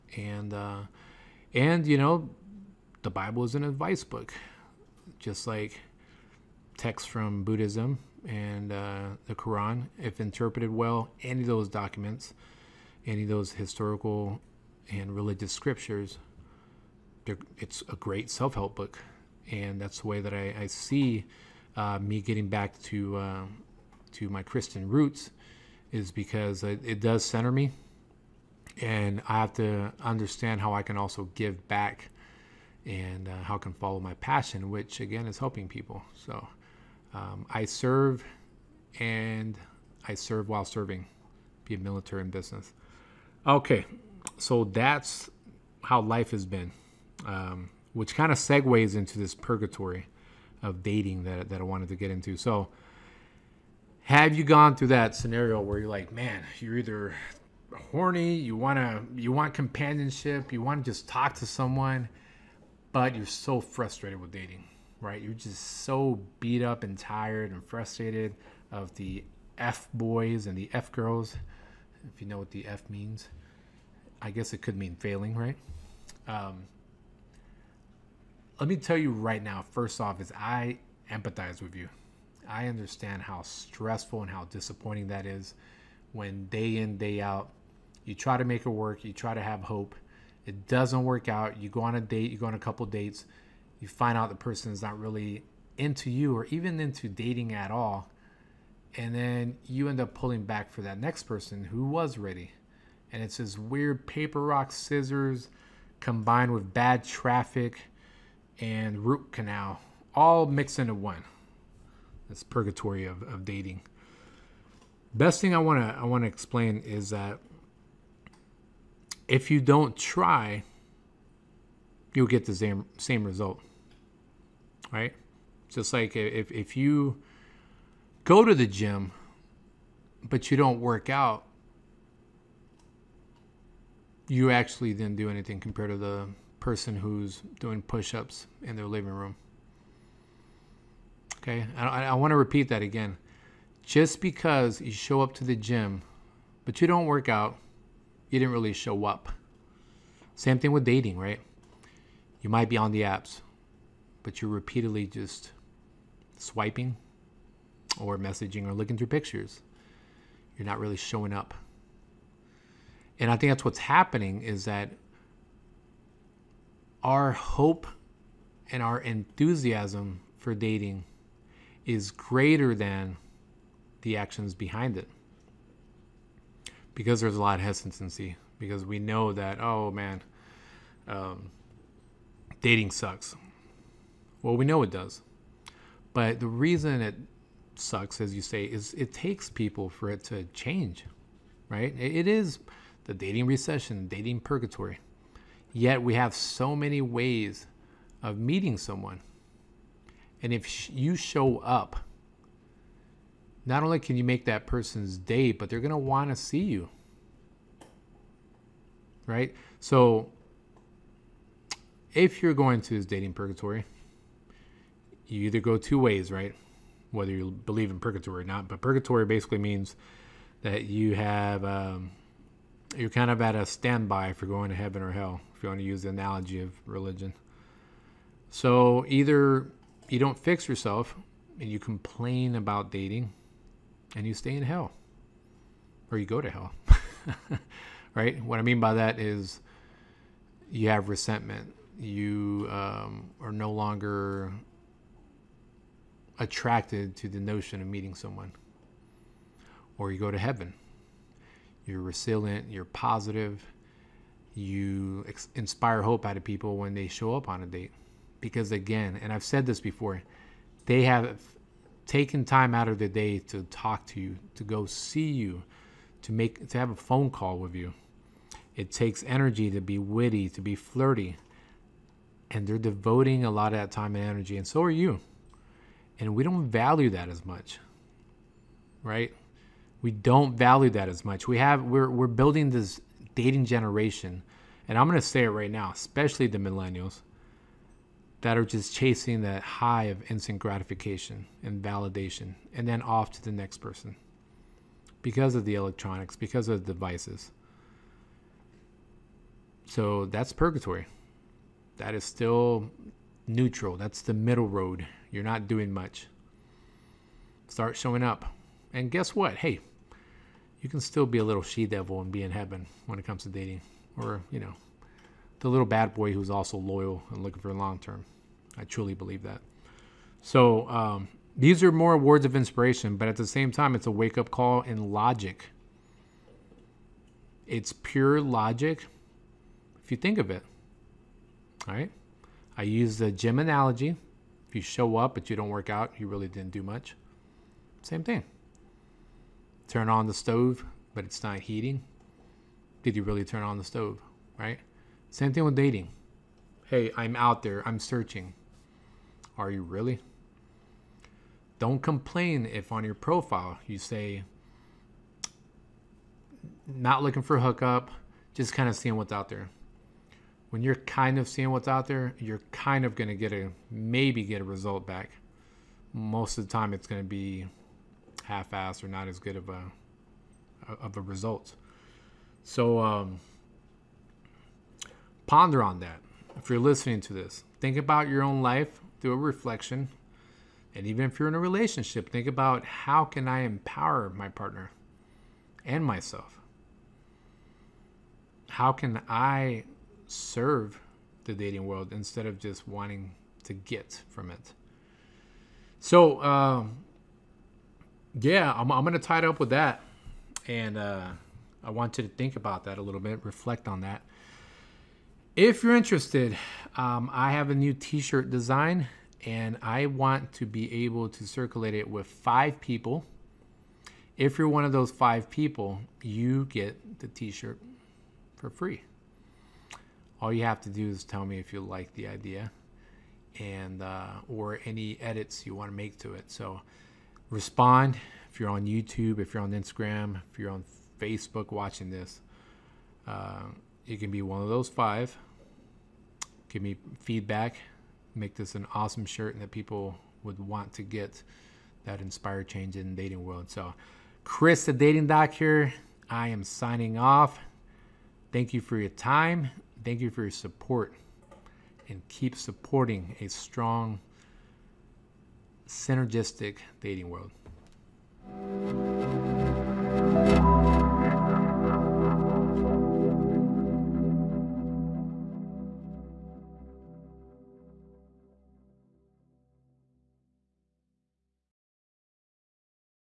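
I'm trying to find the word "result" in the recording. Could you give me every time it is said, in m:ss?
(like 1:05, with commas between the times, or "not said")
2:03, 6:04, 6:11.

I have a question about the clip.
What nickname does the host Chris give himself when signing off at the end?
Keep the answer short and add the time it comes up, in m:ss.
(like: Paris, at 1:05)
the dating doc, at 7:24.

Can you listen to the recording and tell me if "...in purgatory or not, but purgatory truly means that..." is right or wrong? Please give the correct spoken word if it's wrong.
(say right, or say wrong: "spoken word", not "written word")
wrong: "basically", not "truly".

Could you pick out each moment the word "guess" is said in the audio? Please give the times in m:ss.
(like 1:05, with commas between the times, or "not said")
1:14, 5:09.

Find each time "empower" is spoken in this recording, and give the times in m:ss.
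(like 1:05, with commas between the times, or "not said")
6:23.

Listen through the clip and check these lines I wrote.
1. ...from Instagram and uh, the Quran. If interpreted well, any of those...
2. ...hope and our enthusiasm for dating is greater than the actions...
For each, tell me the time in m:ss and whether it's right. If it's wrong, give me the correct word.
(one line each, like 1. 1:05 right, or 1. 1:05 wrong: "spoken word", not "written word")
1. 0:07 wrong: "Buddhism", not "Instagram"
2. 2:47 right.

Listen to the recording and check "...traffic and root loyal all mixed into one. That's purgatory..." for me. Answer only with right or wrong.
wrong.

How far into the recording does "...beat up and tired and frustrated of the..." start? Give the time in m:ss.
1:06.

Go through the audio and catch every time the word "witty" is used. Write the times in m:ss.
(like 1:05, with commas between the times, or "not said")
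4:29.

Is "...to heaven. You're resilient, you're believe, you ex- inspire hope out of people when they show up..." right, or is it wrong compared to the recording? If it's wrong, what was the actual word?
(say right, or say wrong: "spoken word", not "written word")
wrong: "positive", not "believe".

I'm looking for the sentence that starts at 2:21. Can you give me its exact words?
Okay, I, I want to repeat that again.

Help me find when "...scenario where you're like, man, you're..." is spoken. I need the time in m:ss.
0:55.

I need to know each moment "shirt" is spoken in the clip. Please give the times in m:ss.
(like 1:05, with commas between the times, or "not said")
6:48, 6:57, 7:19.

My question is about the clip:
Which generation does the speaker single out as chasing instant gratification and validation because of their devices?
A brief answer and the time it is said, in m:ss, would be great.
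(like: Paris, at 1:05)
millennials, at 4:46.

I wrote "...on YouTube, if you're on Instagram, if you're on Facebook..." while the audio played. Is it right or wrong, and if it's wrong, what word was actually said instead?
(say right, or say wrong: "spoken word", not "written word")
right.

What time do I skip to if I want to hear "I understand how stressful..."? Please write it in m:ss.
1:22.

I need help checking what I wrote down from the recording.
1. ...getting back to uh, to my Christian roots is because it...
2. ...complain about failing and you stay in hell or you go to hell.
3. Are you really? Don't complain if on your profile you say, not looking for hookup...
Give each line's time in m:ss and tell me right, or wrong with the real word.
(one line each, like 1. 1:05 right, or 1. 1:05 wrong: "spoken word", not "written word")
1. 0:22 right
2. 3:51 wrong: "dating", not "failing"
3. 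5:49 right.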